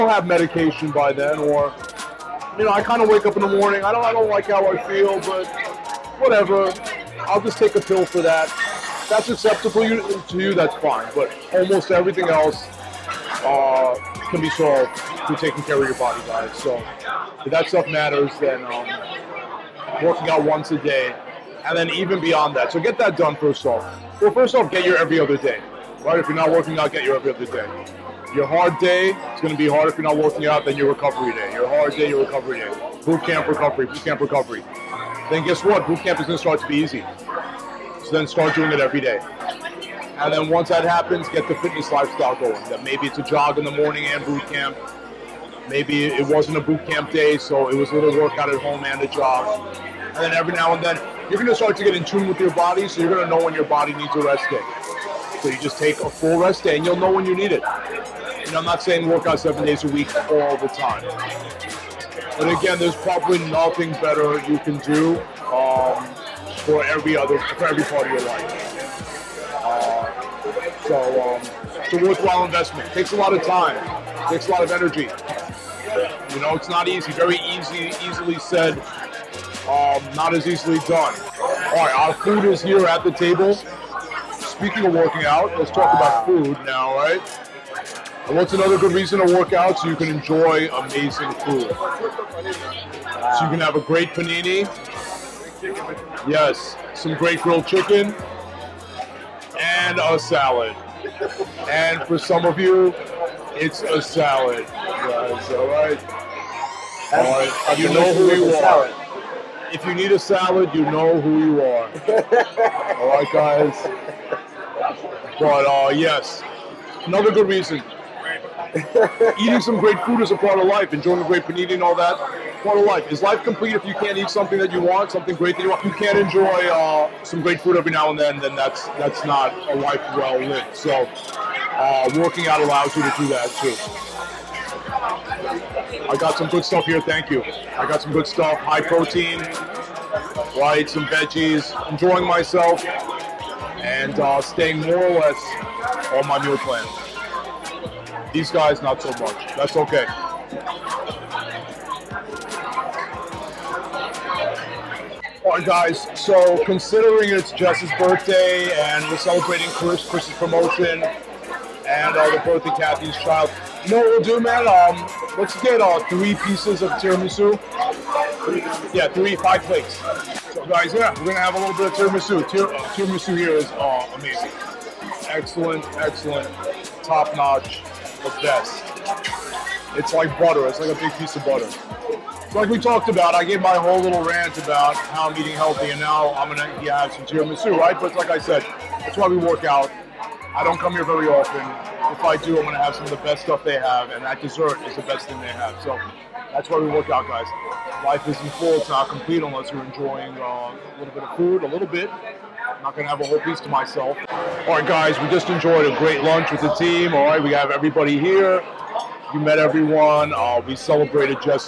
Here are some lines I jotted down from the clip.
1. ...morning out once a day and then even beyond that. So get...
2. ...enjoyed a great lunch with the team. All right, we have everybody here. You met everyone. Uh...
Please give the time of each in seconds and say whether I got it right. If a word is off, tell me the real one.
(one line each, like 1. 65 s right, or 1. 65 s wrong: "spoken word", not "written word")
1. 20 s wrong: "working", not "morning"
2. 205 s right.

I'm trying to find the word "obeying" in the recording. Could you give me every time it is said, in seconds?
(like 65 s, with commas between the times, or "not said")
not said.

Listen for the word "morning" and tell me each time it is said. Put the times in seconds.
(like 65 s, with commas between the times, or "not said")
3 s, 43 s.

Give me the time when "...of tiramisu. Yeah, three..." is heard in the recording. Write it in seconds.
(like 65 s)
166 s.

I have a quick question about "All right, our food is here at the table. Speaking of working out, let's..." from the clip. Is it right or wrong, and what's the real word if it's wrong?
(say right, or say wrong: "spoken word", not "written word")
right.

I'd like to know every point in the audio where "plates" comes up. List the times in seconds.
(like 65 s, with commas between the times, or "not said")
169 s.